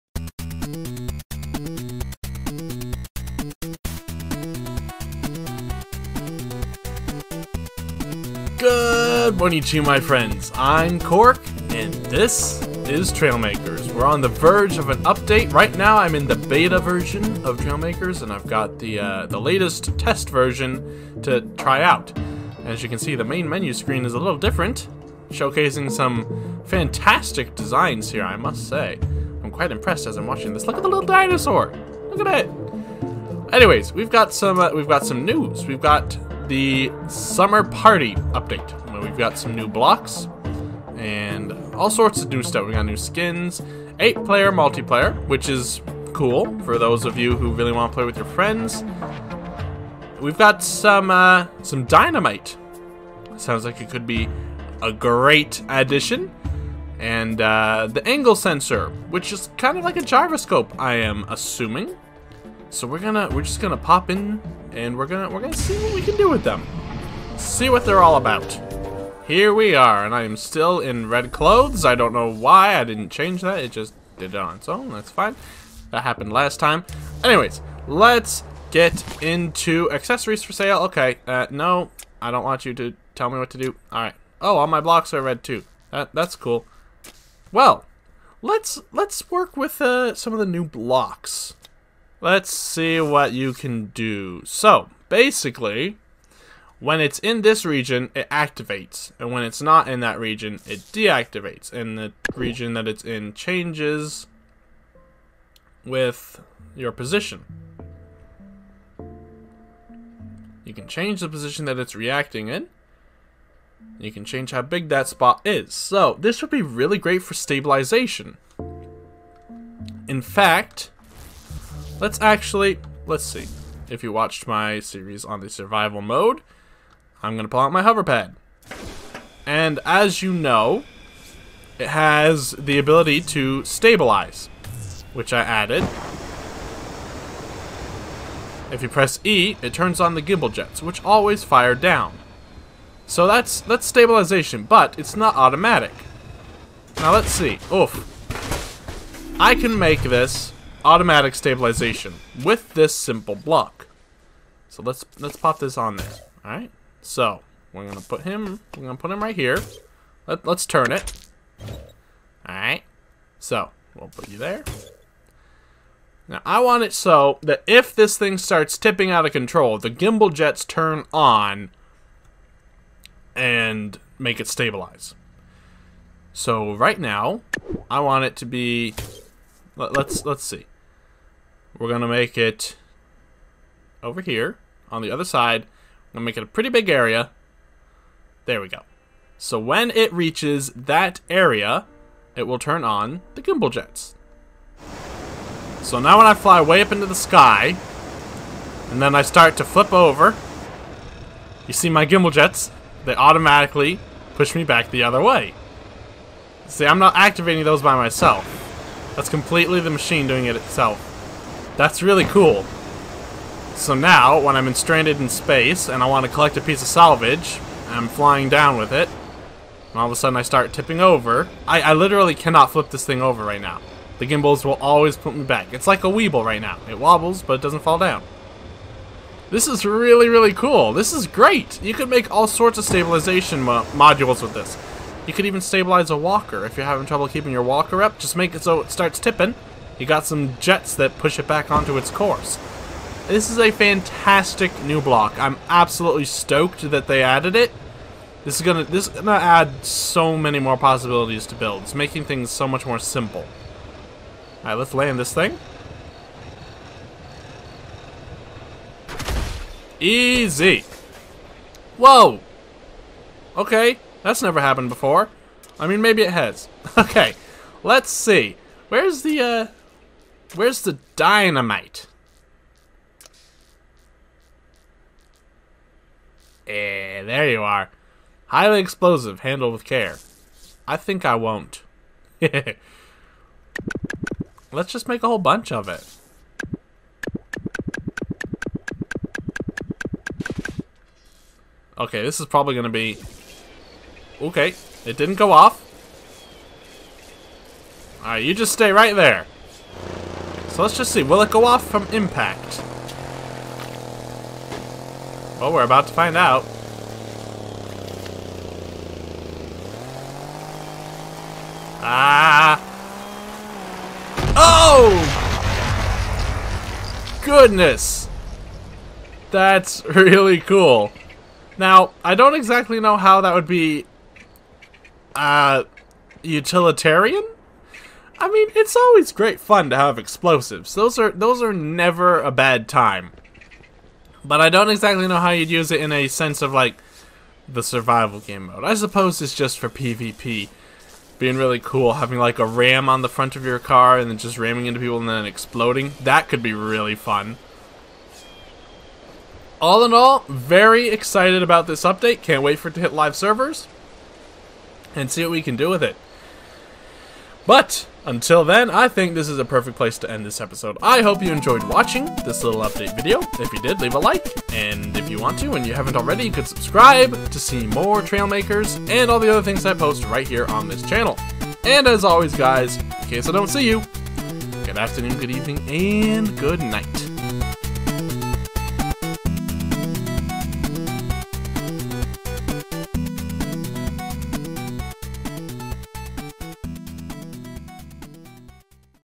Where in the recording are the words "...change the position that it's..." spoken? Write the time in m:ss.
1:50.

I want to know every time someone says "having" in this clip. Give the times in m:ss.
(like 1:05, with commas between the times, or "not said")
3:56, 5:42.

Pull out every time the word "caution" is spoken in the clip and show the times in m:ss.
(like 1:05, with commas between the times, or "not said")
not said.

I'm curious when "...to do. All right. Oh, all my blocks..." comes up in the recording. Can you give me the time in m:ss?
1:23.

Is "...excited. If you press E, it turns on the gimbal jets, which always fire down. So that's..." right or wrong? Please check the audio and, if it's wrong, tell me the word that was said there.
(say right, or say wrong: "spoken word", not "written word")
wrong: "added", not "excited".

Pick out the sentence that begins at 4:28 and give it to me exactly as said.
Where's the, uh, Where's the dynamite?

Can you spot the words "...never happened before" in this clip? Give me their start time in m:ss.
4:24.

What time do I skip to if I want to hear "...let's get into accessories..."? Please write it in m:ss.
1:17.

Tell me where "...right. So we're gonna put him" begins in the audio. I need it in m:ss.
2:36.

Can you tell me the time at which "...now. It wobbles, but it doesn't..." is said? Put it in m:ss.
3:46.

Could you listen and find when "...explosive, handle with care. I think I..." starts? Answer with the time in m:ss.
4:38.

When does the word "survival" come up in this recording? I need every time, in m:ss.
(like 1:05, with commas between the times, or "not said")
2:05, 5:37.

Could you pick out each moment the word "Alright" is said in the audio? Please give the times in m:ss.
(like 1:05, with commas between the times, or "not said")
4:14, 4:58.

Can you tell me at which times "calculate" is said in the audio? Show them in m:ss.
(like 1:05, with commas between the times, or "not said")
not said.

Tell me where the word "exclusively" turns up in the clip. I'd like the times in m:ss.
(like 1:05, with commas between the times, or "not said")
not said.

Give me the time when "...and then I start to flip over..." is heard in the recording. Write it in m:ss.
3:18.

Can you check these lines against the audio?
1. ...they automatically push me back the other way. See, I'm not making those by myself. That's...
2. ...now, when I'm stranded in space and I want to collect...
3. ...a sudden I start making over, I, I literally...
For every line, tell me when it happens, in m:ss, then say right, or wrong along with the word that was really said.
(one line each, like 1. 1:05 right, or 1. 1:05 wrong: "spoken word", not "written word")
1. 3:23 wrong: "activating", not "making"
2. 3:33 right
3. 3:40 wrong: "tipping", not "making".